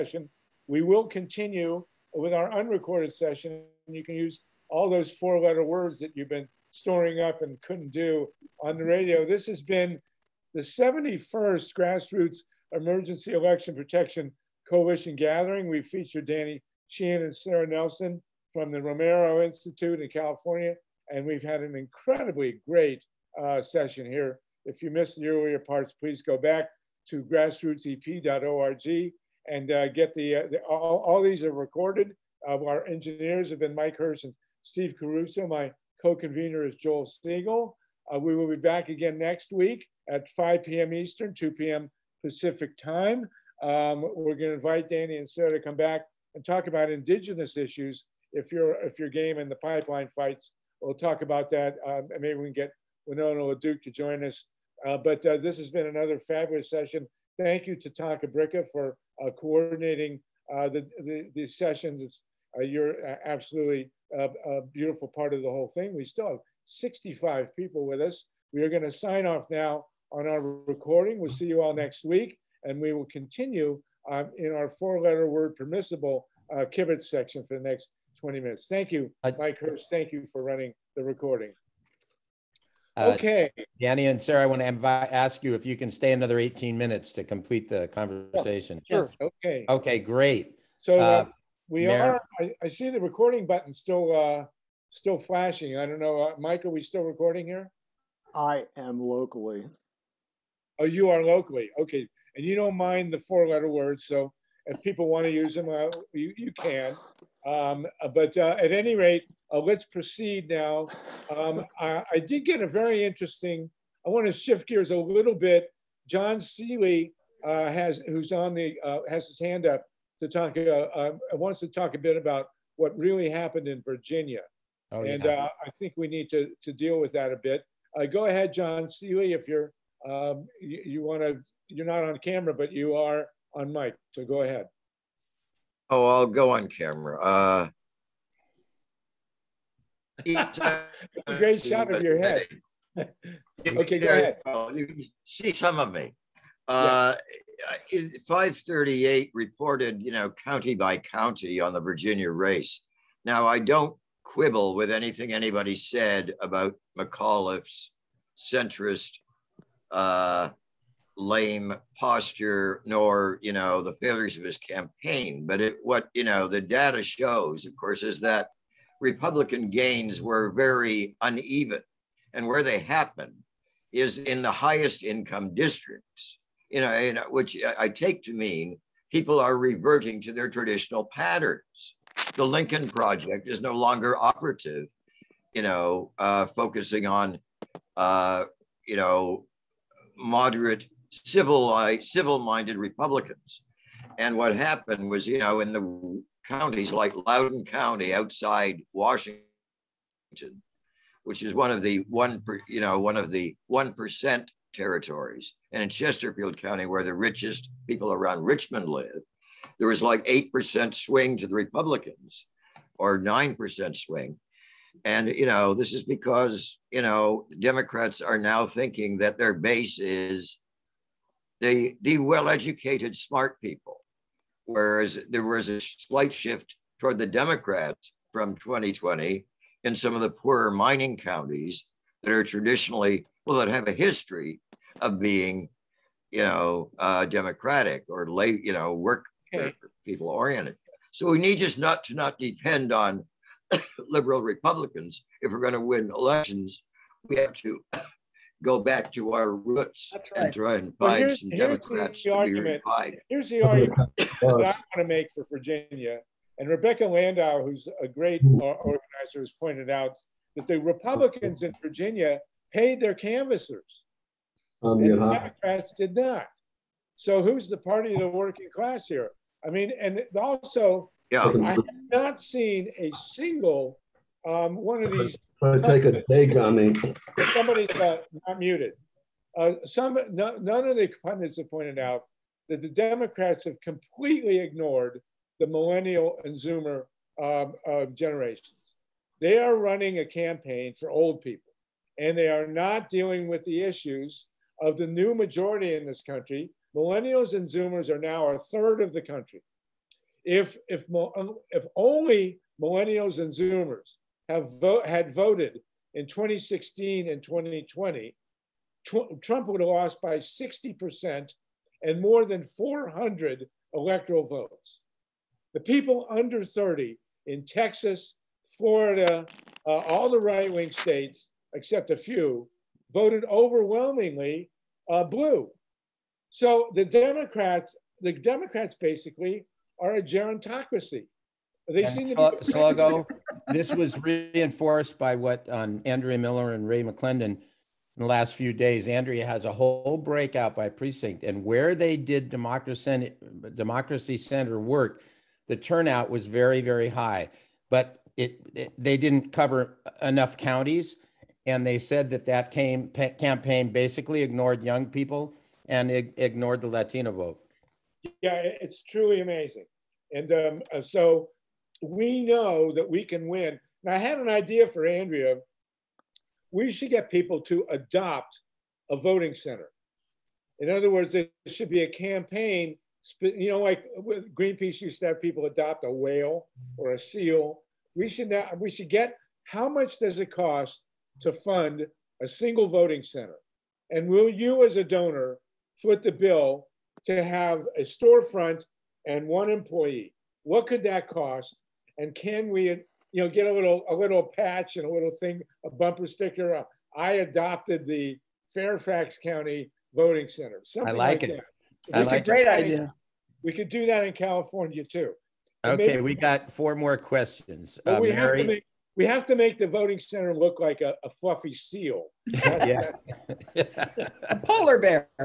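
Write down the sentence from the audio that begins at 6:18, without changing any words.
We should now, we should get how much does it cost to fund a single voting center?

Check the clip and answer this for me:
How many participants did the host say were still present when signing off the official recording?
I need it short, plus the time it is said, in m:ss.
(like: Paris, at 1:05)
65, at 1:06.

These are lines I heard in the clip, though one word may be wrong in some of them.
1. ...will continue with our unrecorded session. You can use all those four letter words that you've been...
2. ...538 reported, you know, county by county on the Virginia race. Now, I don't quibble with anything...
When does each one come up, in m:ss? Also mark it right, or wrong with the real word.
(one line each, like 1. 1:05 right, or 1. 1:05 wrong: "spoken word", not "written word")
1. 0:00 right
2. 2:28 right.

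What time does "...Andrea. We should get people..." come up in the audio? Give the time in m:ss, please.
6:05.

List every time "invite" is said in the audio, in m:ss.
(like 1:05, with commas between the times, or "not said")
0:44, 1:24.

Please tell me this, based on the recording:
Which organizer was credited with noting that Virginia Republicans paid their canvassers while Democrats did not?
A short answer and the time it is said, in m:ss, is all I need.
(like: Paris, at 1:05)
Rebecca Landau, at 4:16.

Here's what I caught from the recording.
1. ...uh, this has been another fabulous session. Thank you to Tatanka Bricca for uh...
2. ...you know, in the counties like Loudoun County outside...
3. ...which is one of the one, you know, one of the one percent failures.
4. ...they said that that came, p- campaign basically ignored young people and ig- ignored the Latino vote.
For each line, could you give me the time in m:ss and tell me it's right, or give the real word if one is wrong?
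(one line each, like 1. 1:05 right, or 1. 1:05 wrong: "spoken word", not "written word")
1. 0:55 right
2. 3:15 right
3. 3:21 wrong: "territories", not "failures"
4. 5:51 right.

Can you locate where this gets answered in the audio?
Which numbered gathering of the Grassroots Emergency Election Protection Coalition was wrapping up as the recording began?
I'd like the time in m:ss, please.
0:10.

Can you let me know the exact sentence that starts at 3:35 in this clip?
And, you know, this is because, you know, Democrats are now thinking that their base is the, the well educated, smart people.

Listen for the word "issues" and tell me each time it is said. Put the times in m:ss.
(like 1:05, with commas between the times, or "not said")
0:47, 4:53.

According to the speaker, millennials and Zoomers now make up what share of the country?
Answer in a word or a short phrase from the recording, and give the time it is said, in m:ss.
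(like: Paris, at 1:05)
a third, at 4:58.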